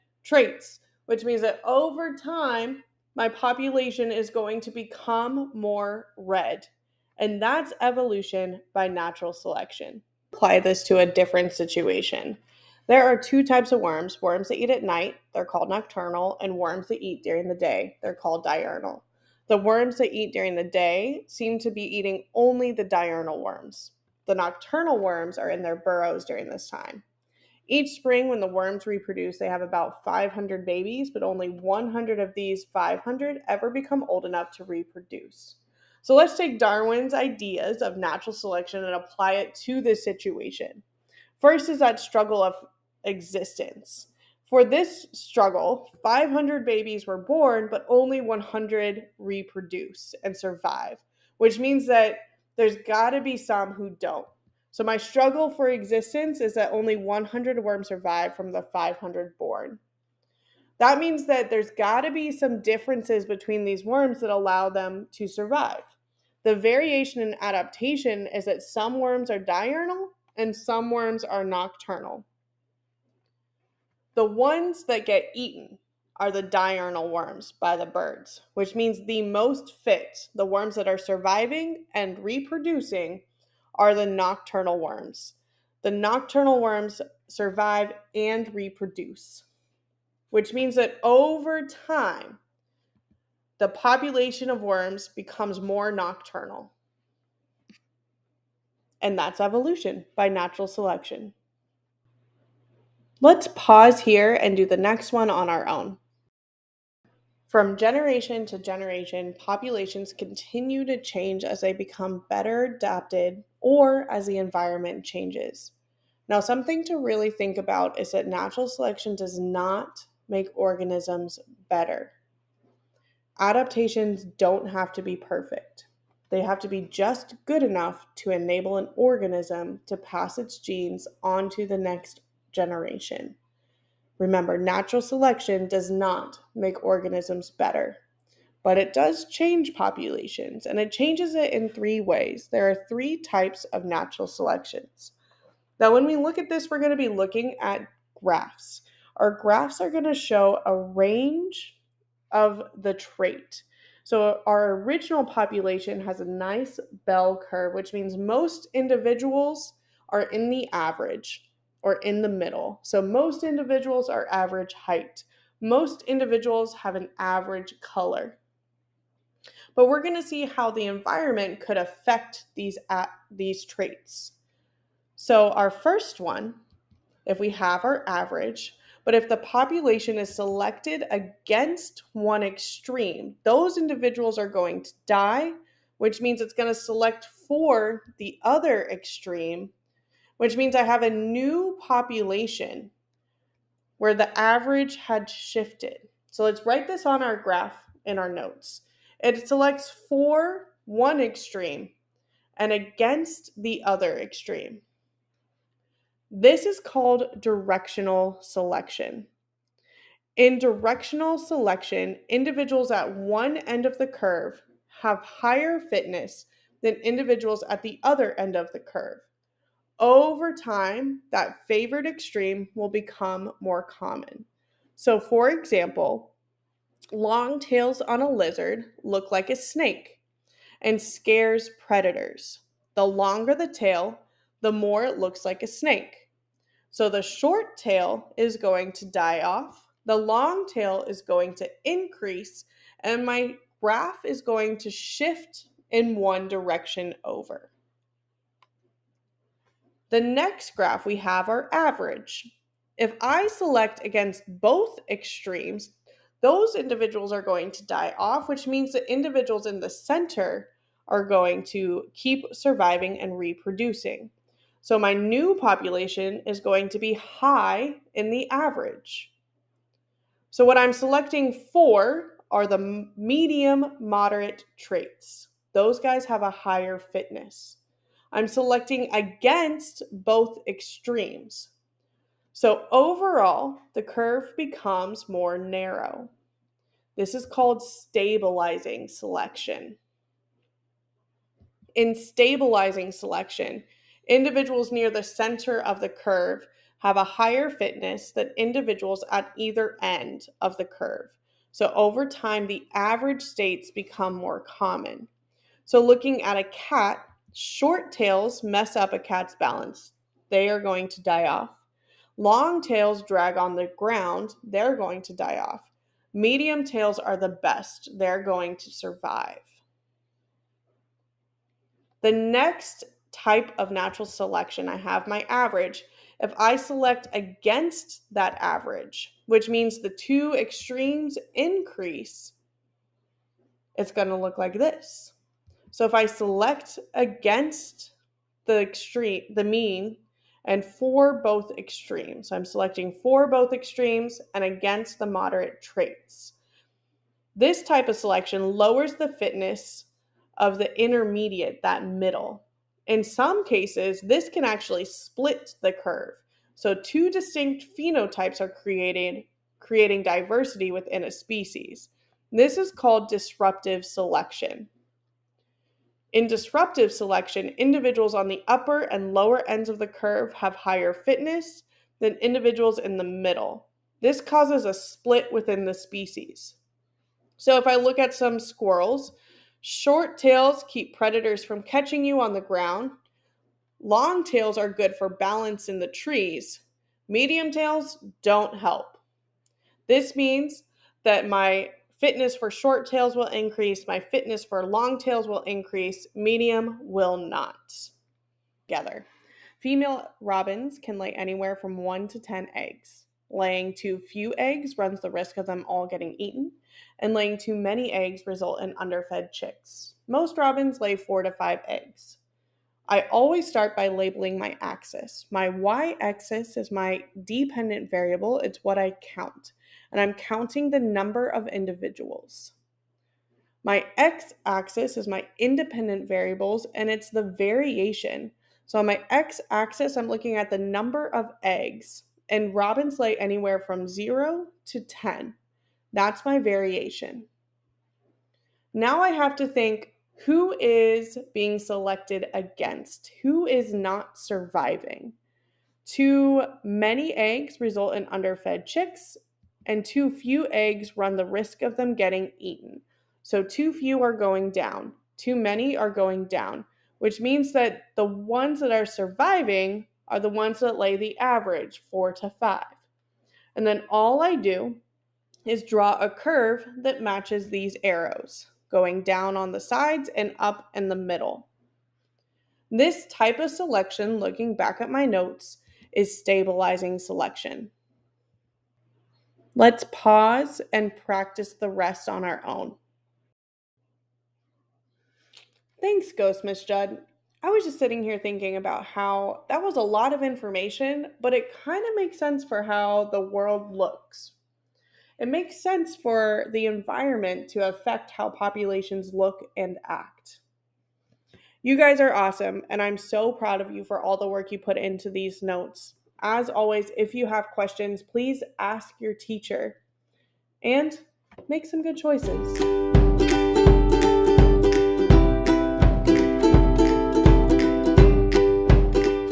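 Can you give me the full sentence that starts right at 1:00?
That means that there's got to be some differences between these worms that allow them to survive.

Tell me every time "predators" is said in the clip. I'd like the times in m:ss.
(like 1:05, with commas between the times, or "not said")
3:51, 6:21.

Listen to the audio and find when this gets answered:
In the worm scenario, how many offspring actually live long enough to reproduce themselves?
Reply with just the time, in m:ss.
0:31.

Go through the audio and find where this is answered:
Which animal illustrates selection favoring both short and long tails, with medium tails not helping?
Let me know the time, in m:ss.
6:18.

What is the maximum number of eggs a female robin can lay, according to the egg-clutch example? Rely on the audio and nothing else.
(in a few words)
10.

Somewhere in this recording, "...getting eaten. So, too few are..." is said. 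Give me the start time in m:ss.
7:32.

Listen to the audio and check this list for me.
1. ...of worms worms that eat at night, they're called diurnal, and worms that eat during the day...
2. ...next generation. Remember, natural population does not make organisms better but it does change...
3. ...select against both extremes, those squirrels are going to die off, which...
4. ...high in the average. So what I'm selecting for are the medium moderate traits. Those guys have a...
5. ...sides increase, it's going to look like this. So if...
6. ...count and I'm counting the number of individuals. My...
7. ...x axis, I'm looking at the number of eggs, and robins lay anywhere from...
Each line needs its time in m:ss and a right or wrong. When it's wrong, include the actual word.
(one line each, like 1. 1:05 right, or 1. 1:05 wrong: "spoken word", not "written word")
1. 0:13 wrong: "nocturnal", not "diurnal"
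2. 2:11 wrong: "selection", not "population"
3. 4:13 wrong: "individuals", not "squirrels"
4. 4:27 right
5. 5:30 wrong: "extremes", not "sides"
6. 6:59 right
7. 7:09 right.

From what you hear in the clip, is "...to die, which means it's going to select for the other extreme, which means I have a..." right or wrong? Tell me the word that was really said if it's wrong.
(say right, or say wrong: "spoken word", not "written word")
right.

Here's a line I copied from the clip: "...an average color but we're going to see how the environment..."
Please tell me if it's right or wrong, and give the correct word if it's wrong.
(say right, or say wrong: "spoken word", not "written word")
right.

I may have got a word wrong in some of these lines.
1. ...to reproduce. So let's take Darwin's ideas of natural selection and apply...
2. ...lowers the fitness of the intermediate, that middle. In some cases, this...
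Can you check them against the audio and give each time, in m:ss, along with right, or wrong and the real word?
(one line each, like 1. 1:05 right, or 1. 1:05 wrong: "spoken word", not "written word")
1. 0:34 right
2. 5:48 right.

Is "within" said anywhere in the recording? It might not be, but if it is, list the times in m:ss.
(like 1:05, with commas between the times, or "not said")
6:00, 6:15.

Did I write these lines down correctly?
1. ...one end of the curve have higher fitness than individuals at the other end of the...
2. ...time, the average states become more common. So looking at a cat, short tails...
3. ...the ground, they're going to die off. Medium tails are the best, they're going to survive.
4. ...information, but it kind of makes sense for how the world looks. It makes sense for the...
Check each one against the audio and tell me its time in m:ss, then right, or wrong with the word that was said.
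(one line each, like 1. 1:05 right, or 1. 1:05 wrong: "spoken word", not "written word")
1. 3:33 right
2. 5:02 right
3. 5:13 right
4. 8:10 right.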